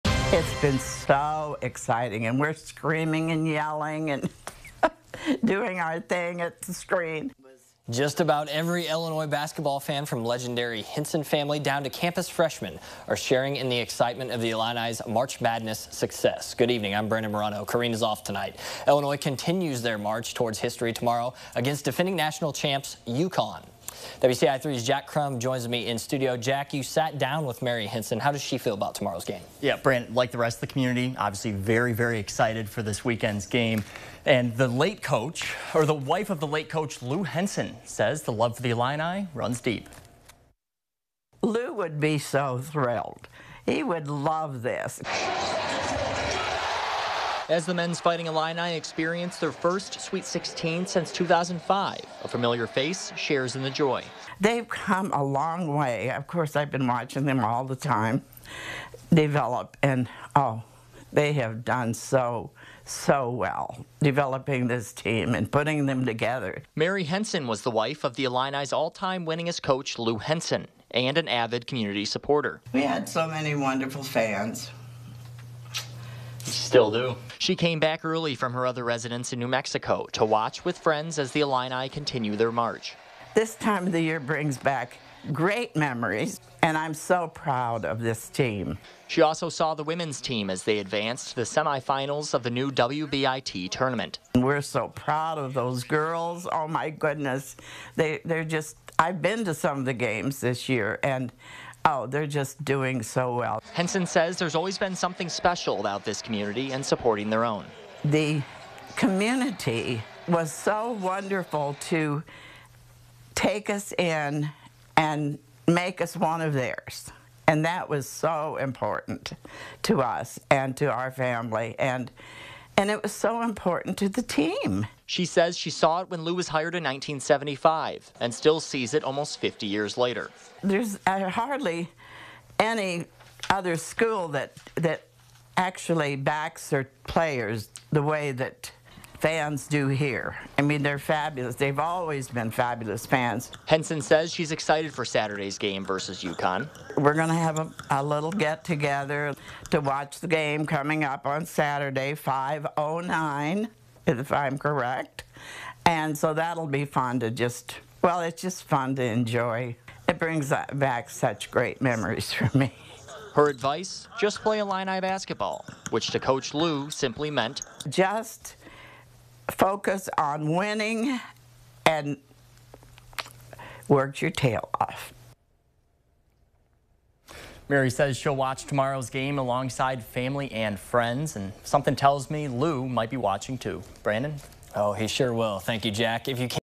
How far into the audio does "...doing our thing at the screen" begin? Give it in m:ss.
0:05.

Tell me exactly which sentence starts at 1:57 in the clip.
And that was so important to us and to our family.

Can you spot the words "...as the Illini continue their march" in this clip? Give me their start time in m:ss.
1:21.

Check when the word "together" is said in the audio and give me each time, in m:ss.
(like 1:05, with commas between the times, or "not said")
1:06, 2:28.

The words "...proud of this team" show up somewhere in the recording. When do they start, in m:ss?
1:27.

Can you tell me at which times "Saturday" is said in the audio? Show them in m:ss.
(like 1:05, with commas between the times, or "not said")
2:25, 2:31.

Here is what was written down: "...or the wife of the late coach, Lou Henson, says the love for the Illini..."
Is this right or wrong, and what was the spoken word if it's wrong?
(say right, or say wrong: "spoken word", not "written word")
right.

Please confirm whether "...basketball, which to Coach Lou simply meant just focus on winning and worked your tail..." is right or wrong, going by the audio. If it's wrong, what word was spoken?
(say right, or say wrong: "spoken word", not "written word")
right.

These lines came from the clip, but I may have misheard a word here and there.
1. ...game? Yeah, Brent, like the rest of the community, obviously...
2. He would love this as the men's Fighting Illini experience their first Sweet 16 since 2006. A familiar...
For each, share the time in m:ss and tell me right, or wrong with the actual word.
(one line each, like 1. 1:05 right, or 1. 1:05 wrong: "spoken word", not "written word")
1. 0:29 right
2. 0:43 wrong: "2005", not "2006".